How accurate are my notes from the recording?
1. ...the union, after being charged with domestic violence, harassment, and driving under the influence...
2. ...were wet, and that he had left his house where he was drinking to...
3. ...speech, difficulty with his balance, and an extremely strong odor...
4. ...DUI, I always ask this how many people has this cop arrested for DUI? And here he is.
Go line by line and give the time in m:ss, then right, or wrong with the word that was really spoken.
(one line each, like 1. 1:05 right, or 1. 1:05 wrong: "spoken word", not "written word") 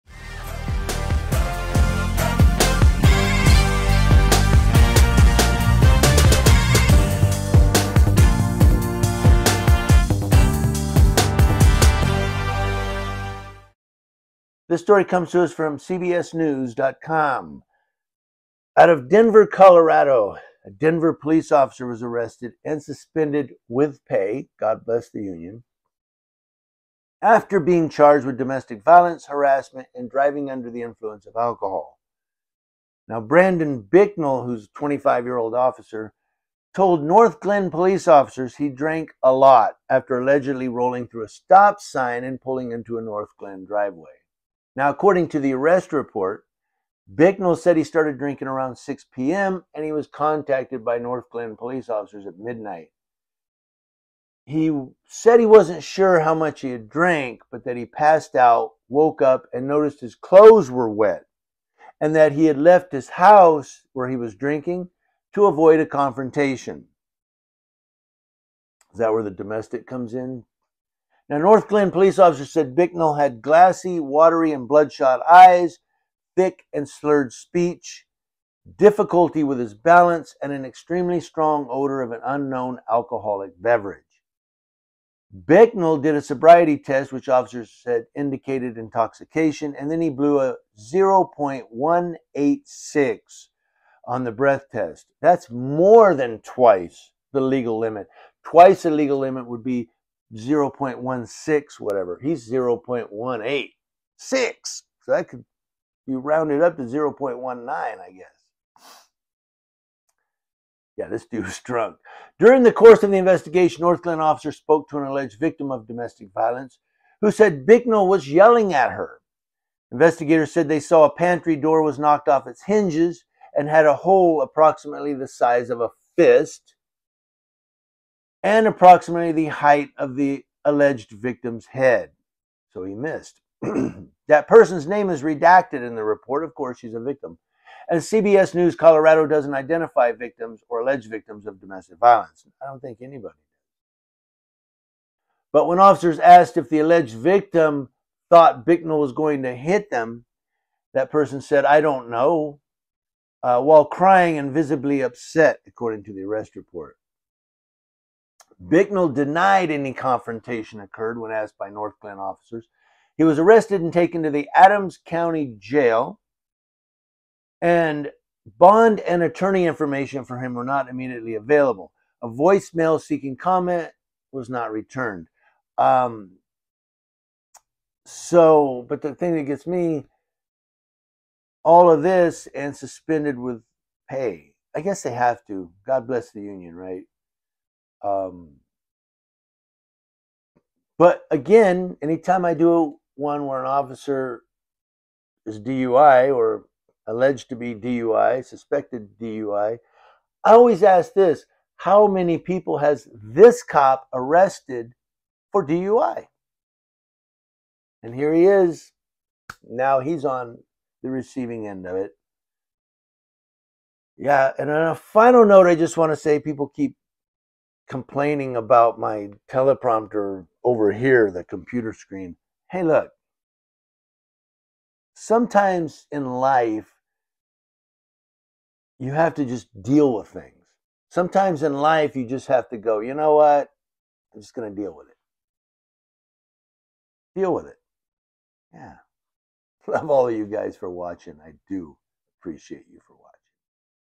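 1. 0:25 right
2. 1:00 right
3. 1:17 right
4. 3:19 right.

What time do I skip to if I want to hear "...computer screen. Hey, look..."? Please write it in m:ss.
3:41.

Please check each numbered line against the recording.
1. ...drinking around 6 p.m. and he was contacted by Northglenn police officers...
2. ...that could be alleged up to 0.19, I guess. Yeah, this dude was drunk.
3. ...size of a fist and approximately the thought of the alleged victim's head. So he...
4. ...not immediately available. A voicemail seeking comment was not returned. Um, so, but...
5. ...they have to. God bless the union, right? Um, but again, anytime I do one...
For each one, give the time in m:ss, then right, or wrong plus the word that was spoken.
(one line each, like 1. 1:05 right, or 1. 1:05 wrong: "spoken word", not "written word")
1. 0:48 right
2. 1:45 wrong: "rounded", not "alleged"
3. 2:05 wrong: "height", not "thought"
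4. 2:50 right
5. 3:05 right.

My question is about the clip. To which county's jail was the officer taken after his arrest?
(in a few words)
Adams County.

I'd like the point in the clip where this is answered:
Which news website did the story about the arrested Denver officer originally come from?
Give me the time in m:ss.
0:15.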